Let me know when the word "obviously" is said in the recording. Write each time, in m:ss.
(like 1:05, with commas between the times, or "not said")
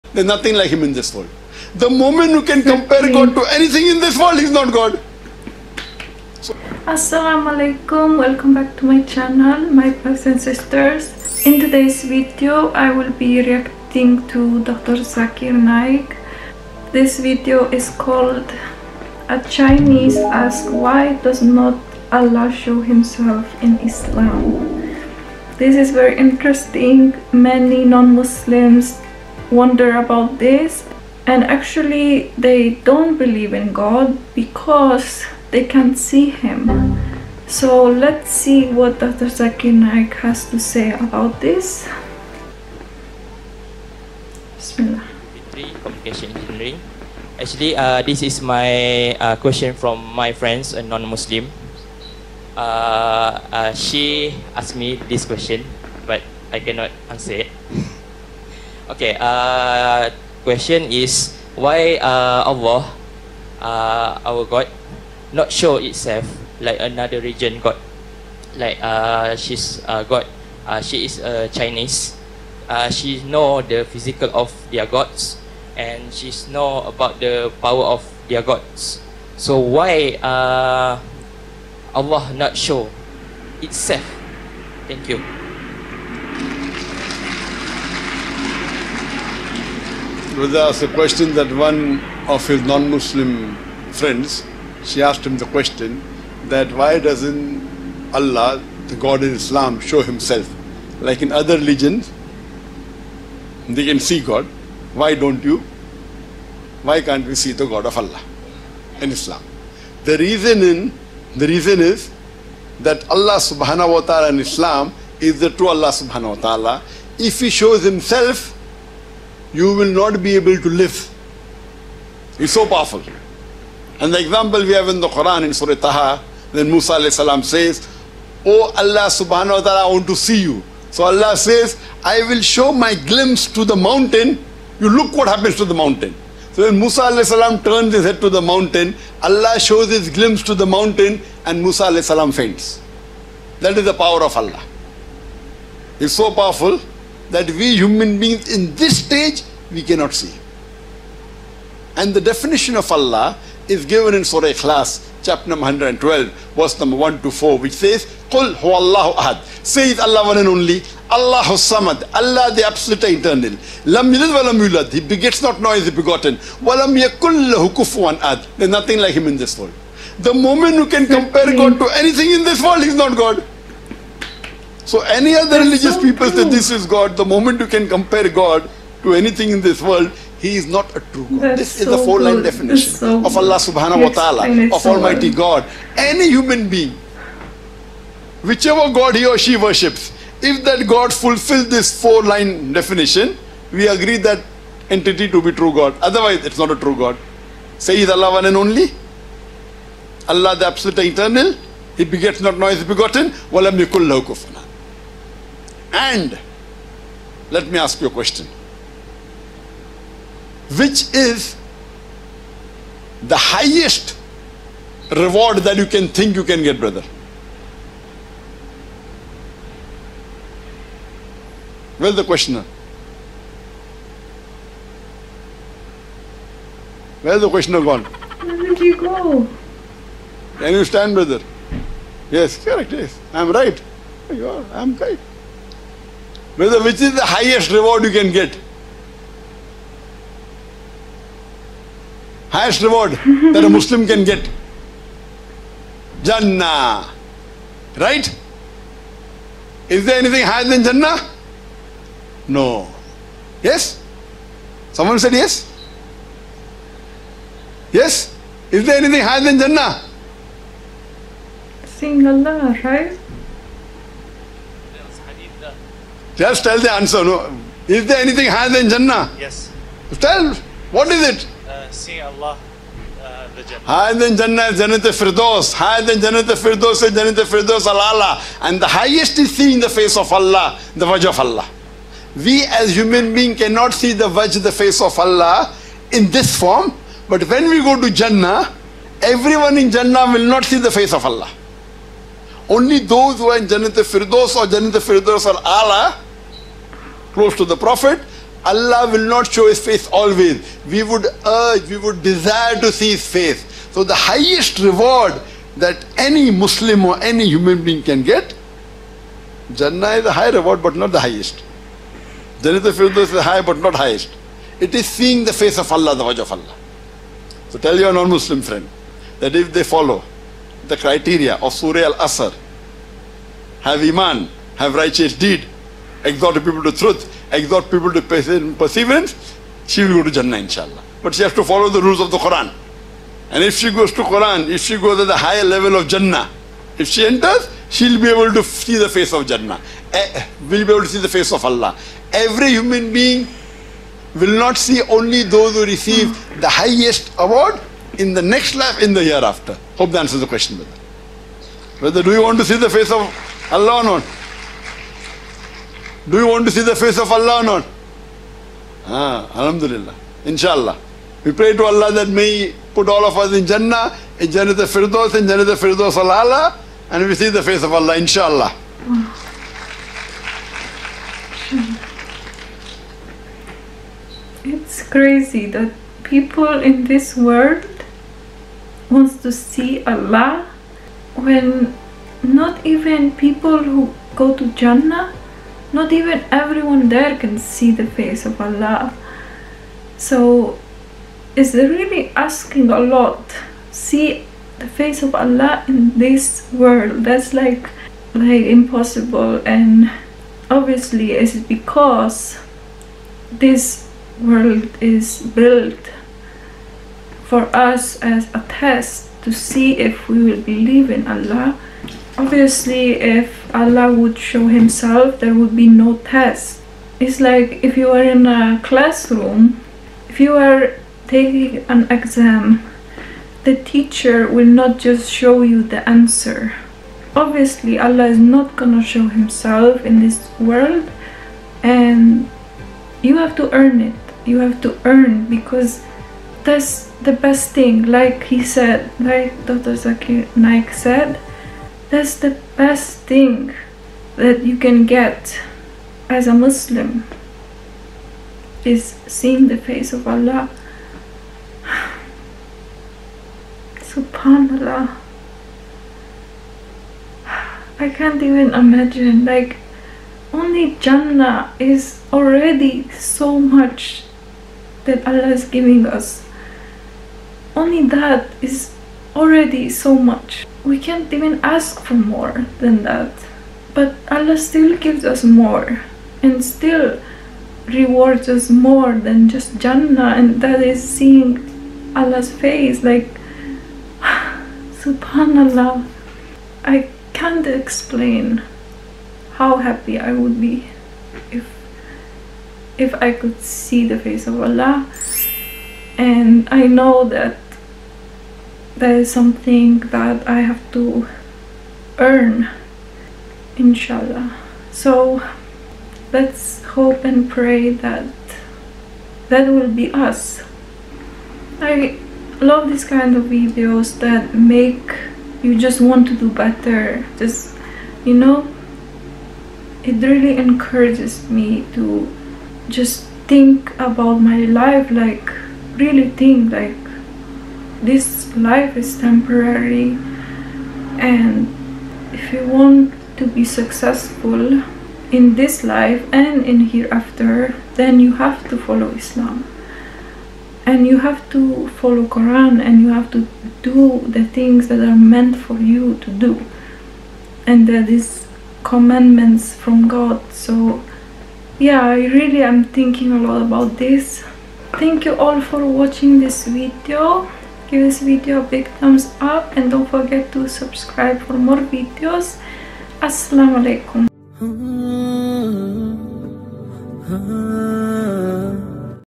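6:40, 6:52, 7:07.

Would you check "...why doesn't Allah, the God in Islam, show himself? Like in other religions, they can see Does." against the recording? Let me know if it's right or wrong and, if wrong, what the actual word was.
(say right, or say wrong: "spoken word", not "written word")
wrong: "God", not "Does".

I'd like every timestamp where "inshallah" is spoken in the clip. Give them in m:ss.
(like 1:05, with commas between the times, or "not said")
5:30, 6:00, 6:08, 8:23.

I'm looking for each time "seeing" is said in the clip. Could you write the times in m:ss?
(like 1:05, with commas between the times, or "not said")
4:21, 4:31, 4:39, 5:15, 7:29, 8:01.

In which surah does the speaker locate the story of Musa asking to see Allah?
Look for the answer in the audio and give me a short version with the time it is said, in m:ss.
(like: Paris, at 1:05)
Surah Taha, at 2:05.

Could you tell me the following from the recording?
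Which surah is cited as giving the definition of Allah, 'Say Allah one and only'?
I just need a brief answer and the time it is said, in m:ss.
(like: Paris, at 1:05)
Surah Ikhlas, at 2:34.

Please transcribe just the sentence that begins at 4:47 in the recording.
But when we go to Jannah, everyone in Jannah will not see the face of Allah.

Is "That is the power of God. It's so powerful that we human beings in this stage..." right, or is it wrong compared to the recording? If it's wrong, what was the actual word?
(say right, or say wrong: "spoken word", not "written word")
wrong: "Allah", not "God".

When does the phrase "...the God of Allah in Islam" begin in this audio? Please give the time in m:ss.
1:47.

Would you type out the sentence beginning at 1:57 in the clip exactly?
If he shows himself, you will not be able to live.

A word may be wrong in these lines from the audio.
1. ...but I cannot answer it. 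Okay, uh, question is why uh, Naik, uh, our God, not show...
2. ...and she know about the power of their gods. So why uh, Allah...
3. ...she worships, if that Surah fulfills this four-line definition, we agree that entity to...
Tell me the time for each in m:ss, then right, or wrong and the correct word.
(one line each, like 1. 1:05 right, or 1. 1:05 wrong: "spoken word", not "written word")
1. 0:56 wrong: "Allah", not "Naik"
2. 1:15 right
3. 3:09 wrong: "God", not "Surah".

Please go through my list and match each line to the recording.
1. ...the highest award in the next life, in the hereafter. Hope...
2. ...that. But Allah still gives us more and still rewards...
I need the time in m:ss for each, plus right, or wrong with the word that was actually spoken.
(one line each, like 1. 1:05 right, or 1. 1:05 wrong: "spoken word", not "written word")
1. 5:46 right
2. 7:53 right.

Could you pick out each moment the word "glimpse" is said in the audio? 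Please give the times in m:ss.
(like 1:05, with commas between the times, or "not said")
2:12, 2:20.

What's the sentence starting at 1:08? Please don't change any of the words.
Like uh, she's uh, God, uh, she is a uh, Chinese.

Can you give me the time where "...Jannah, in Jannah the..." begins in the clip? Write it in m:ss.
6:03.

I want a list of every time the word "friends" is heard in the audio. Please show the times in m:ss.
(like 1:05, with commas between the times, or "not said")
0:50, 1:33, 5:18.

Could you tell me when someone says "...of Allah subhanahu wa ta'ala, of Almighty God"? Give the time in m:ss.
3:03.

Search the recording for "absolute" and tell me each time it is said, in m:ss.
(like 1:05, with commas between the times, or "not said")
2:42, 3:20.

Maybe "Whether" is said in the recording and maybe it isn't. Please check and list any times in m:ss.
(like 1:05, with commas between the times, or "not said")
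3:56.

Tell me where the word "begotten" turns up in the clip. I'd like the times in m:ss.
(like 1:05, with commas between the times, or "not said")
2:45, 3:22.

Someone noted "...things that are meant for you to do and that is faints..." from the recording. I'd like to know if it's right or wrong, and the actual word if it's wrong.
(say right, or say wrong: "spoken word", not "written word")
wrong: "commandments", not "faints".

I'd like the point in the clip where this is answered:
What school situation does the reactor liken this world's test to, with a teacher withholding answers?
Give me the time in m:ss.
7:01.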